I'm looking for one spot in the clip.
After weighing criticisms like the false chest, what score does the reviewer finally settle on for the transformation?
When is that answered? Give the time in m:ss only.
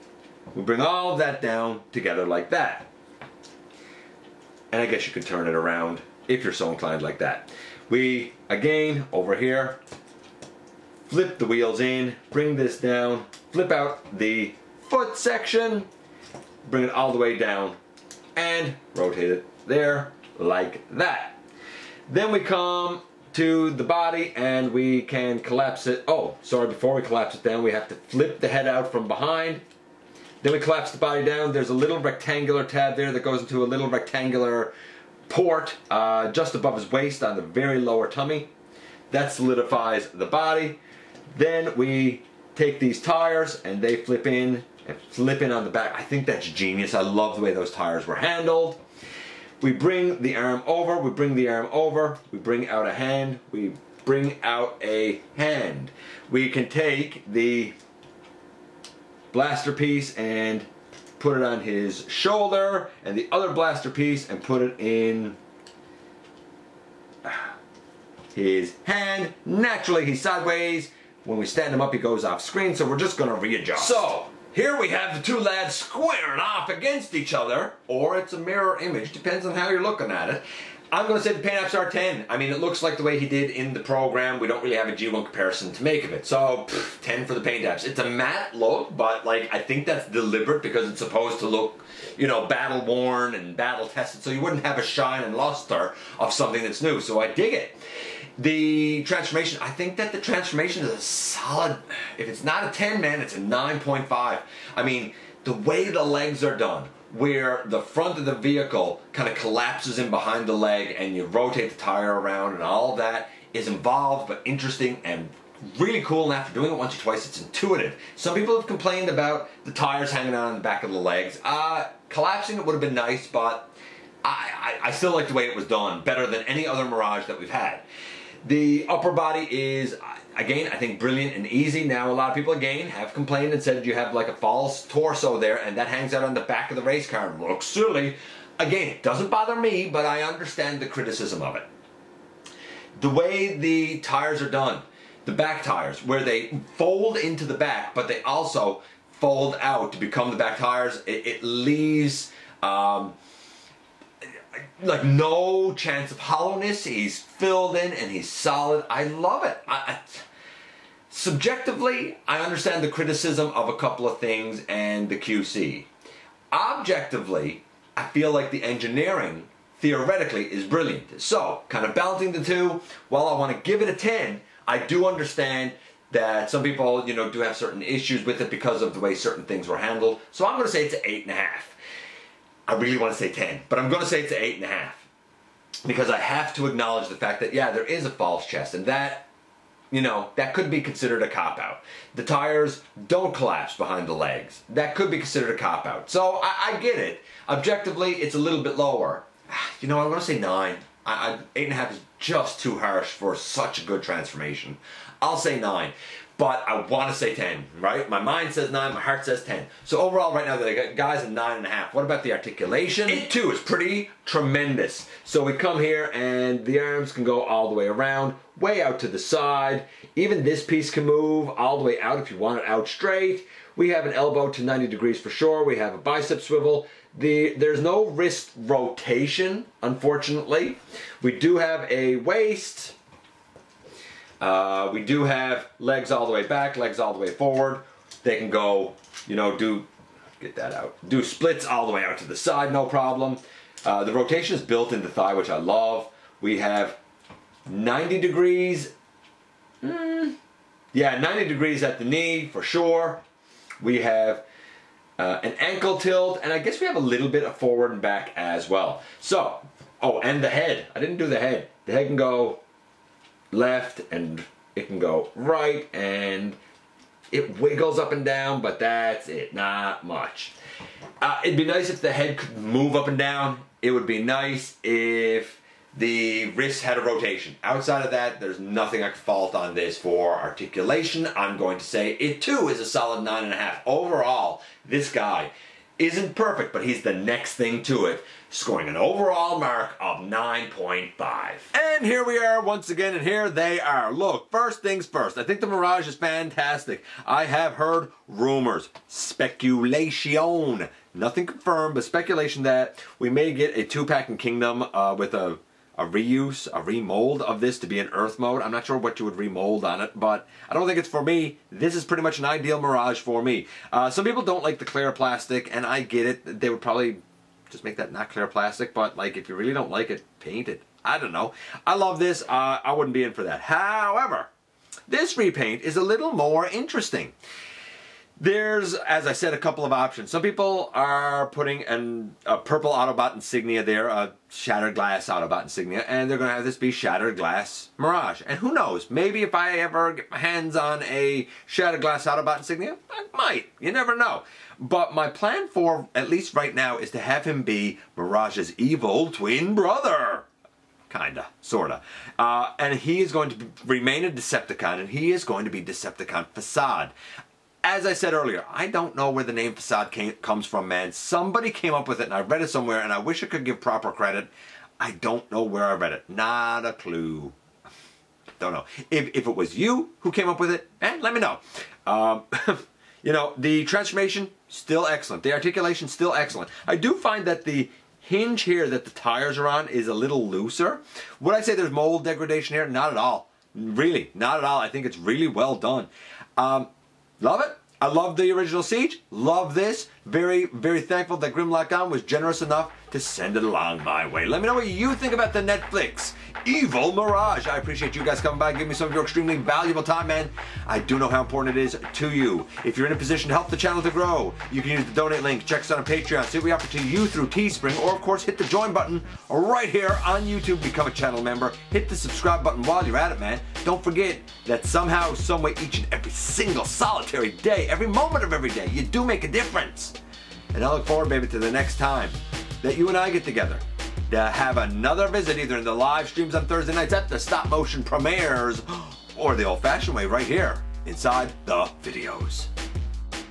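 3:25.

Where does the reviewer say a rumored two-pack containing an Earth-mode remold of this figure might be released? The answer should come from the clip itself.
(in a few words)
Kingdom.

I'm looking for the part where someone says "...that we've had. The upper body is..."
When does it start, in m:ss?
2:07.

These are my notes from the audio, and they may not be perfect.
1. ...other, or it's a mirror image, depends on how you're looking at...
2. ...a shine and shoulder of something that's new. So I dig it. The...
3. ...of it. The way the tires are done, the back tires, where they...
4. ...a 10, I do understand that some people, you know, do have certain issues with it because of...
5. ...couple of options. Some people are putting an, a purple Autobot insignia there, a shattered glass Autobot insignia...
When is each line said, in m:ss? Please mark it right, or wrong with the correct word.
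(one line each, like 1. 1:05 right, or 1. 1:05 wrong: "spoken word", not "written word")
1. 1:17 right
2. 1:34 wrong: "luster", not "shoulder"
3. 2:21 right
4. 2:53 right
5. 5:29 right.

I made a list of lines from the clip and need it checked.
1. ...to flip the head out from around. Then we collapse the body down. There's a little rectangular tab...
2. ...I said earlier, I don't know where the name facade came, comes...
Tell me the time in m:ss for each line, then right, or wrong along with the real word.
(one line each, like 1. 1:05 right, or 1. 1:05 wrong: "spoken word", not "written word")
1. 0:27 wrong: "behind", not "around"
2. 5:58 right.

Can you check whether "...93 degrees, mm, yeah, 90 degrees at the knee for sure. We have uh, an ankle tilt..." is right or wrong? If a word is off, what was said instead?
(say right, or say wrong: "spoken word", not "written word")
wrong: "90", not "93".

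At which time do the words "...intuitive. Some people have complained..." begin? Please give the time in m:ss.
1:57.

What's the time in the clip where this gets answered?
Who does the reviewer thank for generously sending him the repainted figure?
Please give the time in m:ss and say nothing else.
6:31.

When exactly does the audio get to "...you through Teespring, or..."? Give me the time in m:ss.
6:47.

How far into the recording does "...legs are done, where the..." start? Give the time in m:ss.
1:46.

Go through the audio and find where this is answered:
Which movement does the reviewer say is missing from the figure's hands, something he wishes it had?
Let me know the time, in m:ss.
3:48.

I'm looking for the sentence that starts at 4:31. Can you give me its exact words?
Uh, it'd be nice if the head could move up and down.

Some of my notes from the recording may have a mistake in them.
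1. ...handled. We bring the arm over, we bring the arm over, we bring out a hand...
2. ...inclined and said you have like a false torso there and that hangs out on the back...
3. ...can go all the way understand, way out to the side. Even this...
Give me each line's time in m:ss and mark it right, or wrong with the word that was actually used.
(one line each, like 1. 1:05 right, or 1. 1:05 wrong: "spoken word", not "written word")
1. 0:48 right
2. 2:13 wrong: "complained", not "inclined"
3. 3:37 wrong: "around", not "understand".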